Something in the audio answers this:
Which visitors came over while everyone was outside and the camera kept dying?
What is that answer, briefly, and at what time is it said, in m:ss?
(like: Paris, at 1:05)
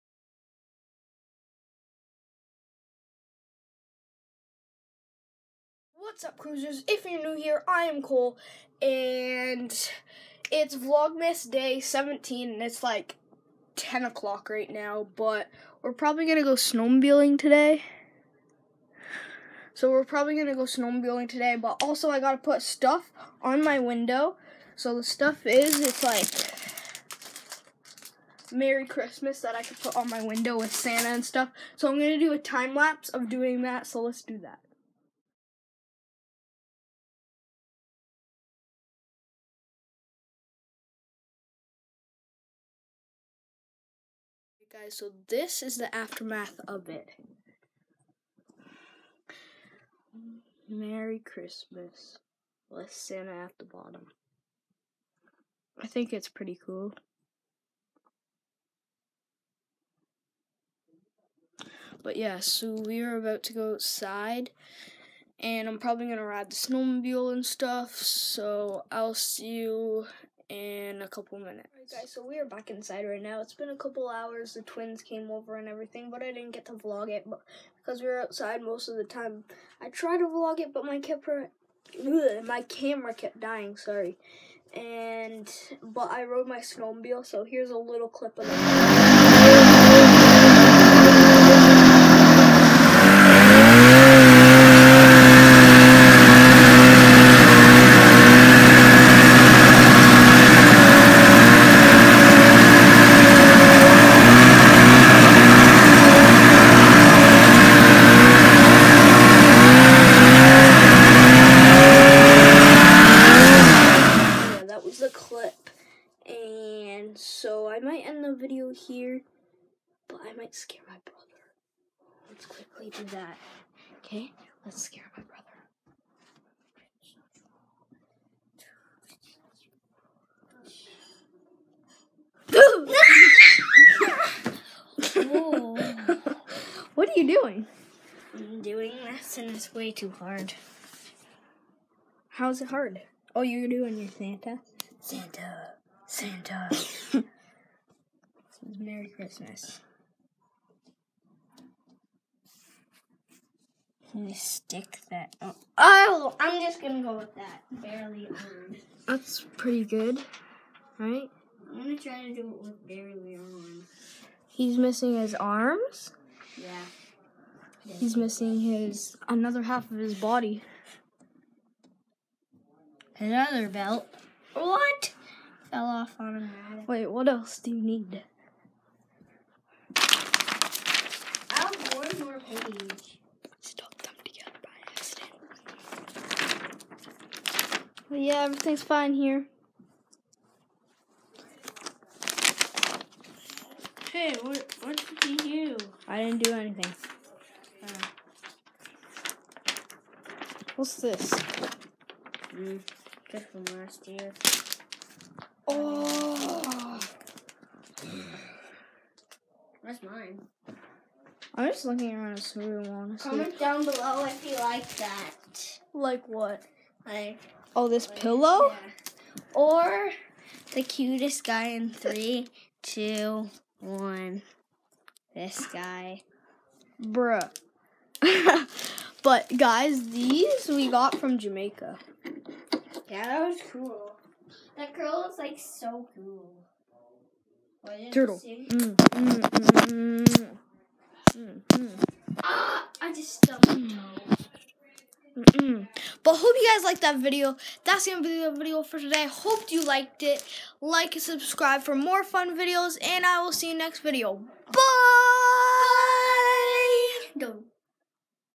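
the twins, at 1:14.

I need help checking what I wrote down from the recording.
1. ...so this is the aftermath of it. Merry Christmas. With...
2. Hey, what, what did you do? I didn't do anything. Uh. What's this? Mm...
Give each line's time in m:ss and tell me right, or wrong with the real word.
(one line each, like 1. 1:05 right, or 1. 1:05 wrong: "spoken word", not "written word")
1. 0:44 right
2. 3:14 right.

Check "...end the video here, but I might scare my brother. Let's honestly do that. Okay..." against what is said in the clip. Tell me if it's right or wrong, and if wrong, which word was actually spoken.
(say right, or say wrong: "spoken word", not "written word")
wrong: "quickly", not "honestly".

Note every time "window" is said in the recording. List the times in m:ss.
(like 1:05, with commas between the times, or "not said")
0:23, 0:30.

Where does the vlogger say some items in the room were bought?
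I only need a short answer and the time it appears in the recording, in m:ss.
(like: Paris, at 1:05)
Jamaica, at 3:51.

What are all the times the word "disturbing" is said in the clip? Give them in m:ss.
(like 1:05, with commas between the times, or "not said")
not said.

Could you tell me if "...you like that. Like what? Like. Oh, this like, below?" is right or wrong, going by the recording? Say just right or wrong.
wrong.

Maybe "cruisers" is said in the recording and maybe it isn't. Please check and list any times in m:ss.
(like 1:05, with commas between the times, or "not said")
0:06.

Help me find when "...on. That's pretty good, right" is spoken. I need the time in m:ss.
2:38.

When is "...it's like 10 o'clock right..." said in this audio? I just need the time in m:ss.
0:12.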